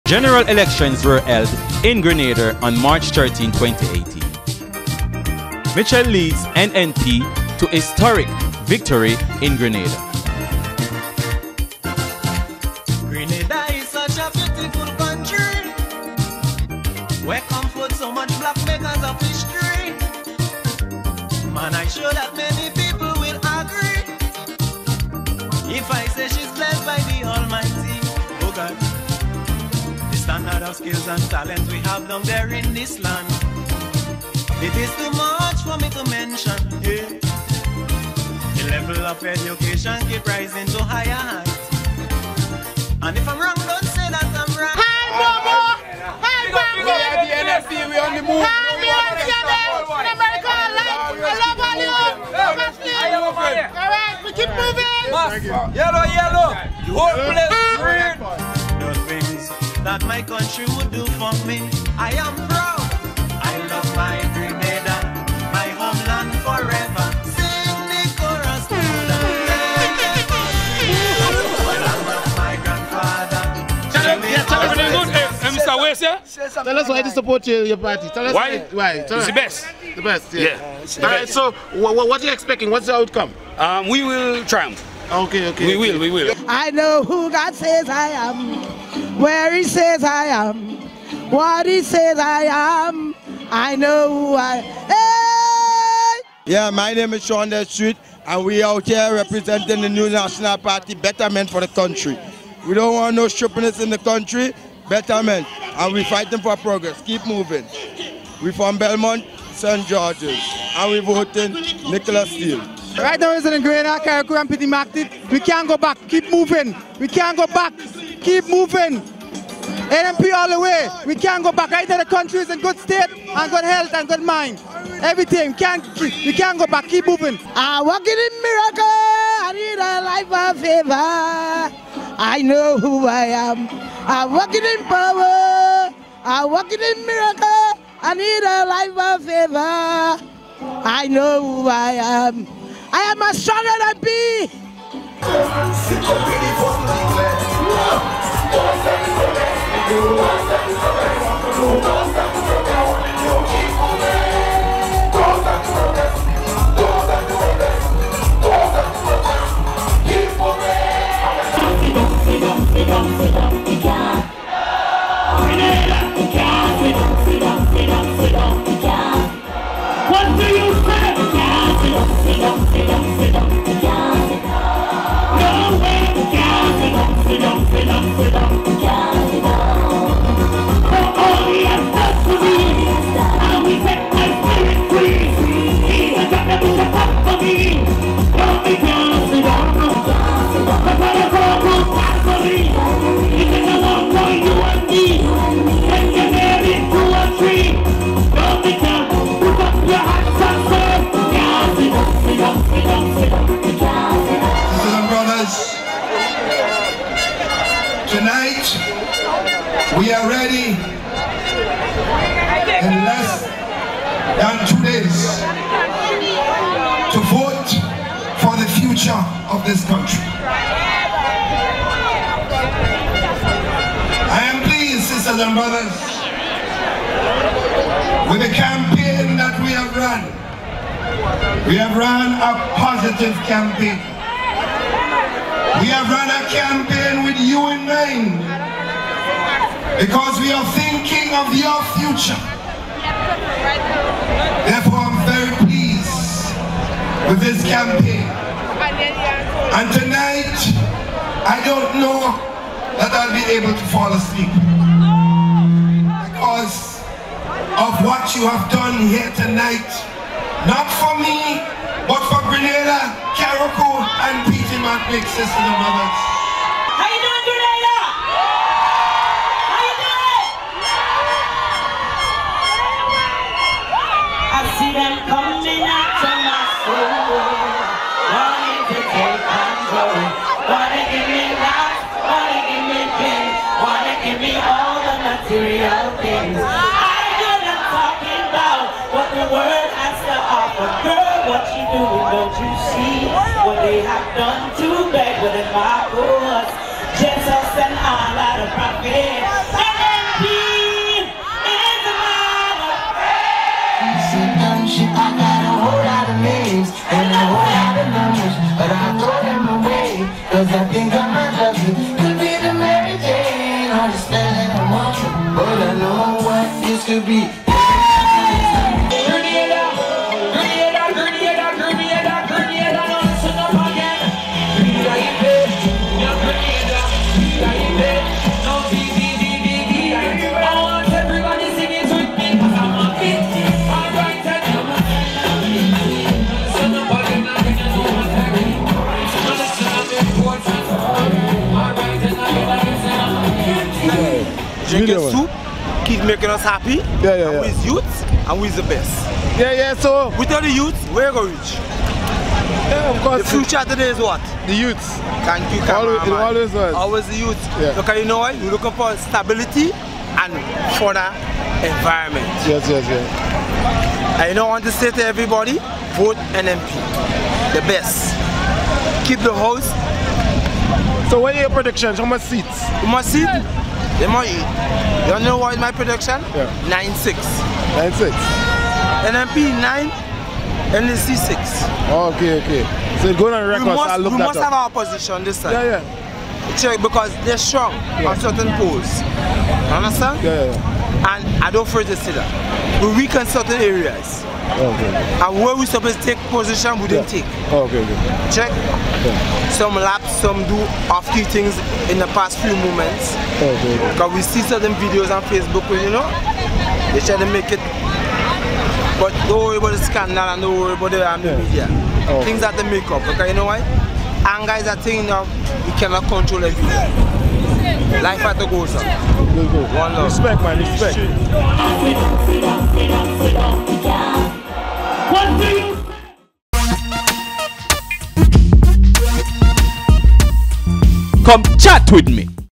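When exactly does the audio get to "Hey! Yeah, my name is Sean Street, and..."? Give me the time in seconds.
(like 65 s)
96 s.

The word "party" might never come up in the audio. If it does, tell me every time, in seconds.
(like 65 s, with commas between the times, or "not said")
77 s, 100 s.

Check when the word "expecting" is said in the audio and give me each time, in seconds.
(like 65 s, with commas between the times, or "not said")
82 s.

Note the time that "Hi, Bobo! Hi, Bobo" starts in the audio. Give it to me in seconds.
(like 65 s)
44 s.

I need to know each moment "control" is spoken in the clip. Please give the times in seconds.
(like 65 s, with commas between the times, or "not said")
279 s, 416 s.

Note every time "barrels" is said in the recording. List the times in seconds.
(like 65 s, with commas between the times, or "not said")
not said.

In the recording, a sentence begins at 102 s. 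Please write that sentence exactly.
We don't want no strippiness in the country, betterment, and we're fighting for progress.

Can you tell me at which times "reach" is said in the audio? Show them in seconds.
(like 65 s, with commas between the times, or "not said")
351 s.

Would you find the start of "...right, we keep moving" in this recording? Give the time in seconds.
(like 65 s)
53 s.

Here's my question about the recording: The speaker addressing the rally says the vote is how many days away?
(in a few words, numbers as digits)
2.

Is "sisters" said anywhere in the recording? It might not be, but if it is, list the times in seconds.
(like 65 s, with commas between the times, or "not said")
225 s, 265 s.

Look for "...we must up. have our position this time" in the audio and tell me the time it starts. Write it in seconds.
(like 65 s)
384 s.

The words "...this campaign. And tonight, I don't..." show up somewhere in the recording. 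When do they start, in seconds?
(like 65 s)
247 s.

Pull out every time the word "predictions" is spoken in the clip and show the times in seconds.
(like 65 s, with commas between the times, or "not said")
371 s, 375 s.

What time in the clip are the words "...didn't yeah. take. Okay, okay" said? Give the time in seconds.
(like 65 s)
397 s.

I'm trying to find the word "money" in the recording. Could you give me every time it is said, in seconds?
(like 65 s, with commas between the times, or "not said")
374 s.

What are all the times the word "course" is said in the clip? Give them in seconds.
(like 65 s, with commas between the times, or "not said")
296 s, 353 s.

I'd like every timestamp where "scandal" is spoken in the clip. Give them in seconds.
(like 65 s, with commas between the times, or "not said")
409 s.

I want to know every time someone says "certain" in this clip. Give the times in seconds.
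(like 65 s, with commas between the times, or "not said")
388 s, 393 s, 404 s.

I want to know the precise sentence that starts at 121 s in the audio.
Either the country is in good state and good health and good mind.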